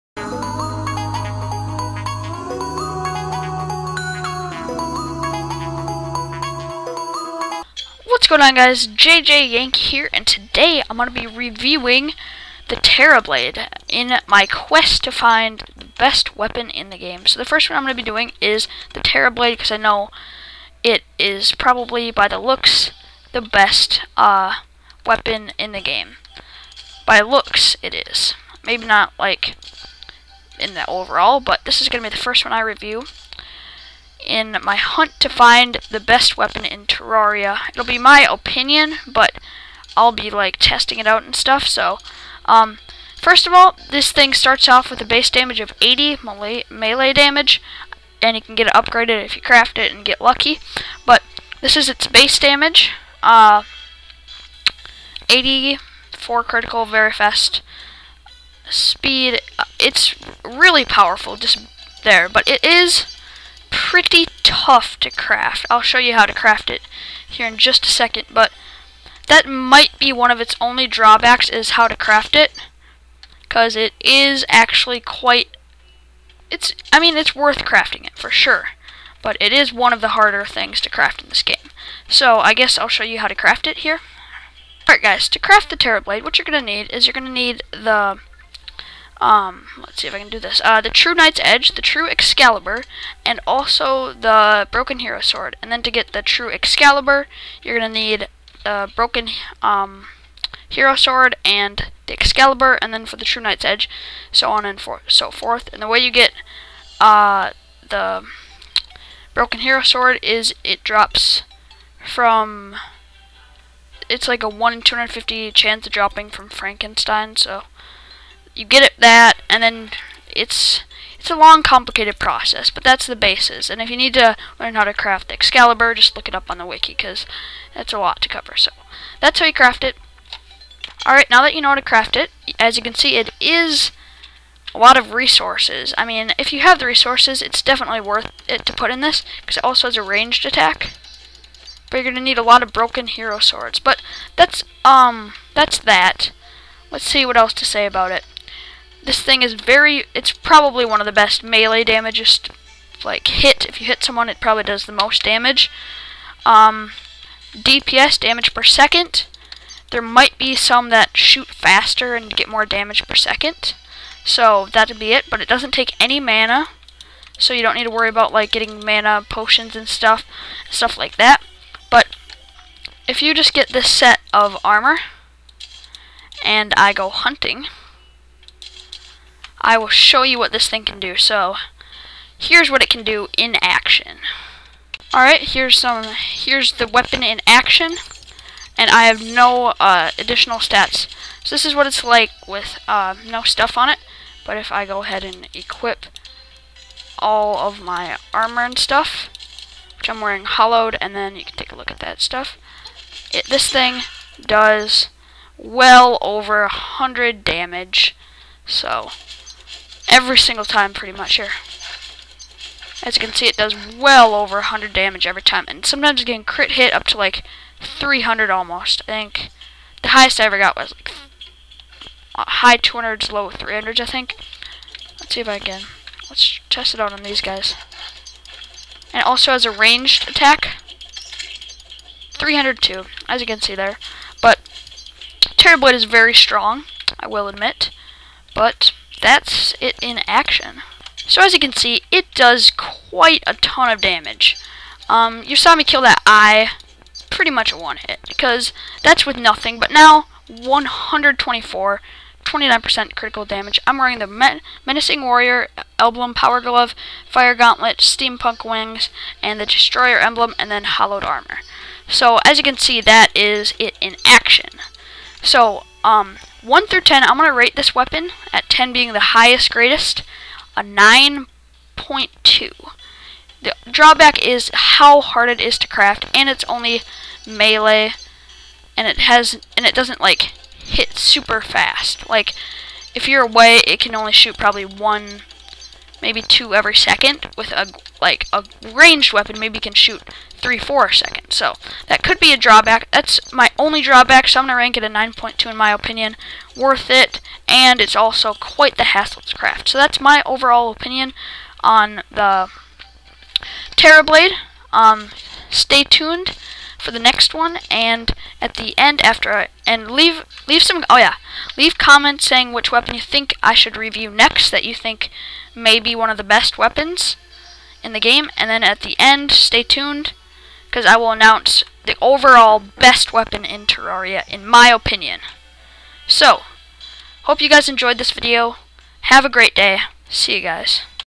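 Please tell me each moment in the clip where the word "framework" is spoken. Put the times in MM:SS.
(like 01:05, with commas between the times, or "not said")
not said.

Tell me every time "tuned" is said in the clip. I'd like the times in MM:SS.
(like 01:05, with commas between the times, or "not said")
05:06, 05:19.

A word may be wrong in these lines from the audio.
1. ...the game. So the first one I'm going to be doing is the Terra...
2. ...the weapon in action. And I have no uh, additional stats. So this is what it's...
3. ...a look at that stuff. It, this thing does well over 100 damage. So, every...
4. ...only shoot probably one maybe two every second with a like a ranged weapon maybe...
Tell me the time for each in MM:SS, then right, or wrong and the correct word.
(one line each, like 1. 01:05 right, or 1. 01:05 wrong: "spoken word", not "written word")
1. 00:16 right
2. 03:06 right
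3. 03:21 right
4. 04:44 right.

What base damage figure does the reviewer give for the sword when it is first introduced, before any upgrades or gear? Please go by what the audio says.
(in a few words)
80.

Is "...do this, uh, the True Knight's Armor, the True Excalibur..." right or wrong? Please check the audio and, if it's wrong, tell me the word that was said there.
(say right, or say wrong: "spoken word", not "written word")
wrong: "Edge", not "Armor".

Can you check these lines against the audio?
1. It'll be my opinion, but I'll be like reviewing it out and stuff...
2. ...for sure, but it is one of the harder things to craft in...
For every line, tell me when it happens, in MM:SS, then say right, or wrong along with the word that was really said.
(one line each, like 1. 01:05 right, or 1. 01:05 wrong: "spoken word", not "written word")
1. 00:37 wrong: "testing", not "reviewing"
2. 01:18 right.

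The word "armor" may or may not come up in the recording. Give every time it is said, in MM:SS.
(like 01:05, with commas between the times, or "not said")
02:54, 03:18, 04:21.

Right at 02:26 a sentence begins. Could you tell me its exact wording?
Let's see what else to say about it.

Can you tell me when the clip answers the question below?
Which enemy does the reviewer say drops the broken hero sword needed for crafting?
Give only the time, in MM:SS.
01:56.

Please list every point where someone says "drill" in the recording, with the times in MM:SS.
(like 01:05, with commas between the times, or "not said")
not said.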